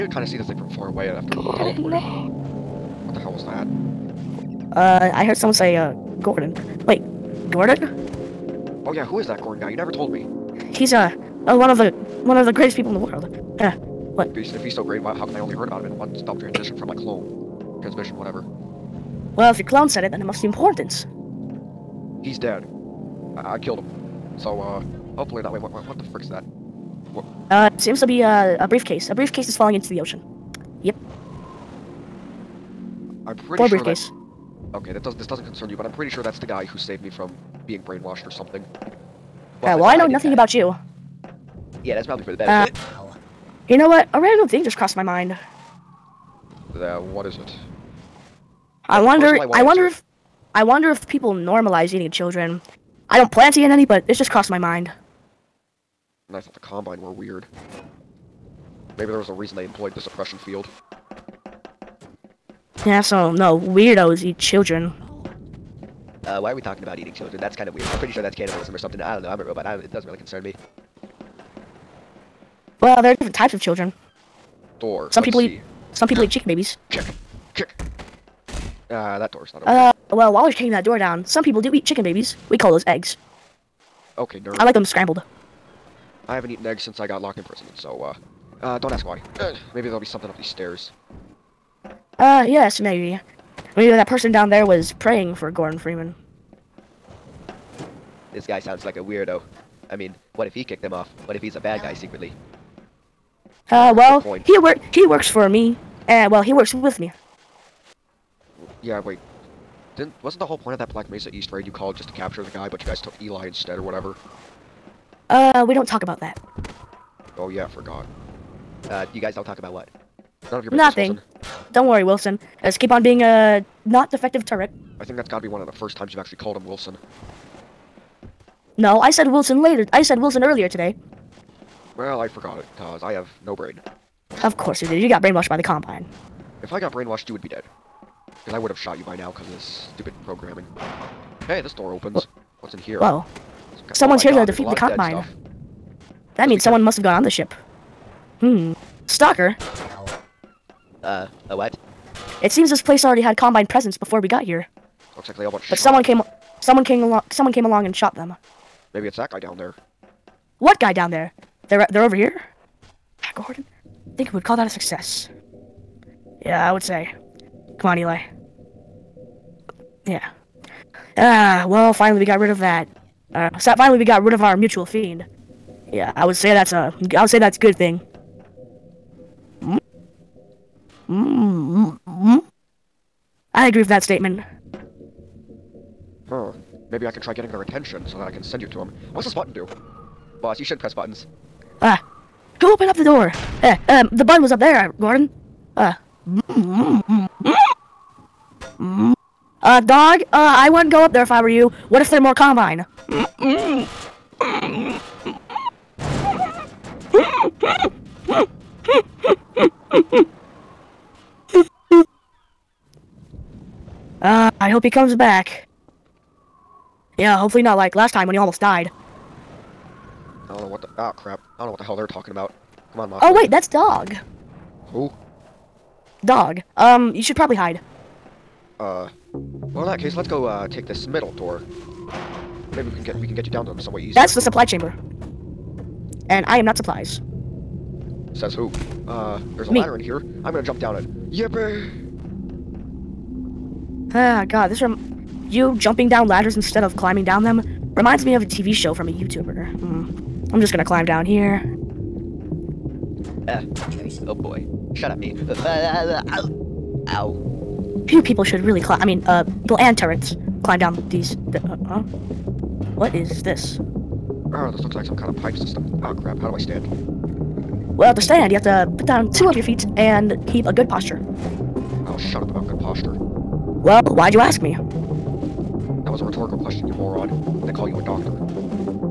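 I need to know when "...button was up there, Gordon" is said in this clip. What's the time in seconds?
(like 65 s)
194 s.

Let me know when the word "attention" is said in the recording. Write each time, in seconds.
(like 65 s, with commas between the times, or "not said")
187 s.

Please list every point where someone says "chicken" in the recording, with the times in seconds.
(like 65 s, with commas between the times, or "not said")
76 s, 81 s.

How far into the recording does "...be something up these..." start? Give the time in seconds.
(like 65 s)
89 s.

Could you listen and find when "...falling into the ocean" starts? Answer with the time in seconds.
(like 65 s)
29 s.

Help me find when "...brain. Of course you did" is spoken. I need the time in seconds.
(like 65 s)
133 s.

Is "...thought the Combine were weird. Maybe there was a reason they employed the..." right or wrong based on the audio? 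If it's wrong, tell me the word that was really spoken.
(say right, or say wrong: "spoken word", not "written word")
right.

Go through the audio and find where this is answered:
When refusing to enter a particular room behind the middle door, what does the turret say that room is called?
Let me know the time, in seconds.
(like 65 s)
234 s.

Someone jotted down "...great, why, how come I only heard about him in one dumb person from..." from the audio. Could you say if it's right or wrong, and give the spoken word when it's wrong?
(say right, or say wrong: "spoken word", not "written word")
wrong: "transition", not "person".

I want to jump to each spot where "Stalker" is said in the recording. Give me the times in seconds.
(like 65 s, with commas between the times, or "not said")
149 s.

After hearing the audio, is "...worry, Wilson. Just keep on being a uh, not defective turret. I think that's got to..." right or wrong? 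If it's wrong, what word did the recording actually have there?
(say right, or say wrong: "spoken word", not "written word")
right.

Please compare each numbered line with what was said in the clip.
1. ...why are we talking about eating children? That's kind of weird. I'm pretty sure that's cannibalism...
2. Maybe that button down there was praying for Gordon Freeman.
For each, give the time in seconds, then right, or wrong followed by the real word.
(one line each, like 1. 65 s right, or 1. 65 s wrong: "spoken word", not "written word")
1. 66 s right
2. 93 s wrong: "person", not "button".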